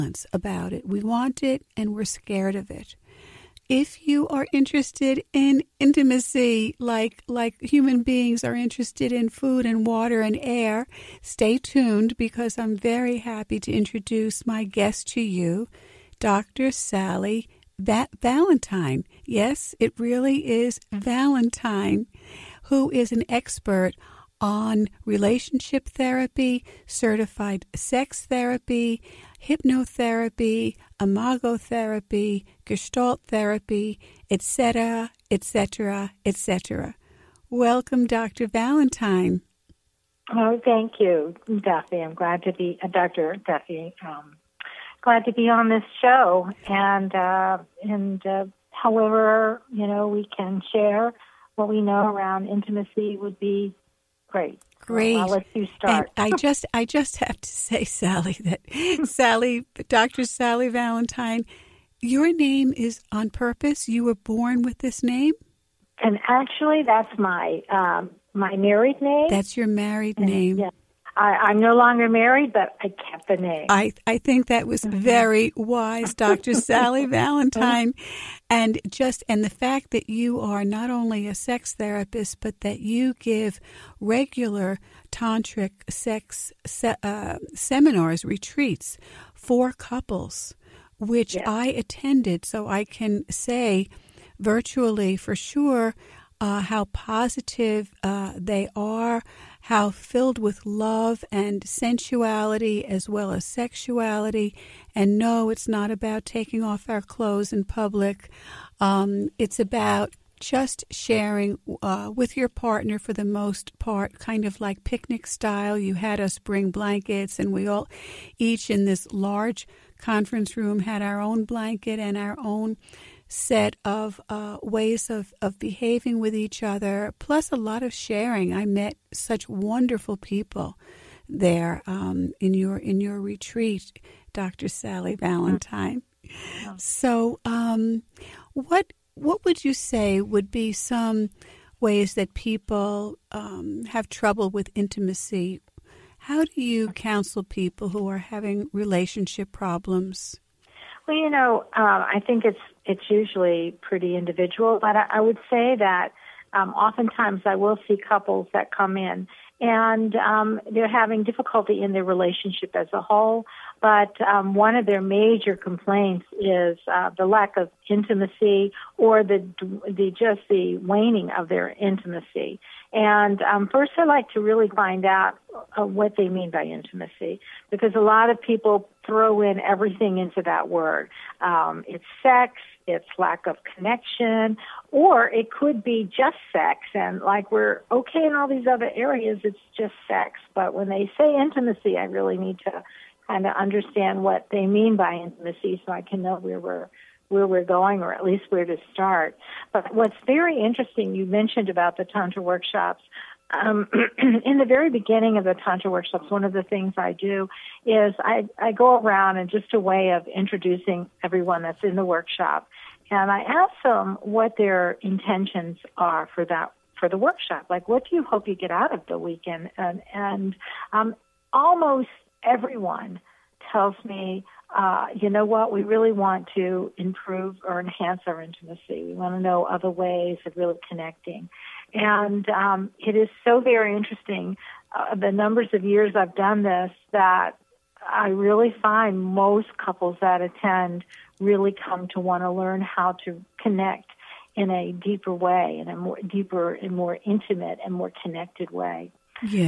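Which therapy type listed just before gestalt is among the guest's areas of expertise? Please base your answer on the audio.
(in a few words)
Imago therapy.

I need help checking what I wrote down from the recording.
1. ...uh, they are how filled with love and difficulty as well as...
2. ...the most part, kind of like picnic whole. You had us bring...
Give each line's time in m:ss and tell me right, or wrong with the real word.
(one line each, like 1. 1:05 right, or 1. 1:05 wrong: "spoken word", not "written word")
1. 1:38 wrong: "sensuality", not "difficulty"
2. 1:53 wrong: "style", not "whole".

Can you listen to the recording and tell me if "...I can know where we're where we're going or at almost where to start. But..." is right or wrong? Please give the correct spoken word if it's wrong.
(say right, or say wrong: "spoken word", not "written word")
wrong: "least", not "almost".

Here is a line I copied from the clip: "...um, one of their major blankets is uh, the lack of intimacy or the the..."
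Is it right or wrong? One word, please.
wrong.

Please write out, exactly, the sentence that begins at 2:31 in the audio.
Well, you know, um, I think it's it's usually pretty individual.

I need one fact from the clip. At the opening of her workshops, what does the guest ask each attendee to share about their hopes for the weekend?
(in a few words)
Their intentions.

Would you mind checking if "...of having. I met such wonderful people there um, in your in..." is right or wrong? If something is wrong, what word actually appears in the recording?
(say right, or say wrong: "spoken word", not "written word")
wrong: "sharing", not "having".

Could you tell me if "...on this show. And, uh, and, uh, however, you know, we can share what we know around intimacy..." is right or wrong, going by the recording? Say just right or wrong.
right.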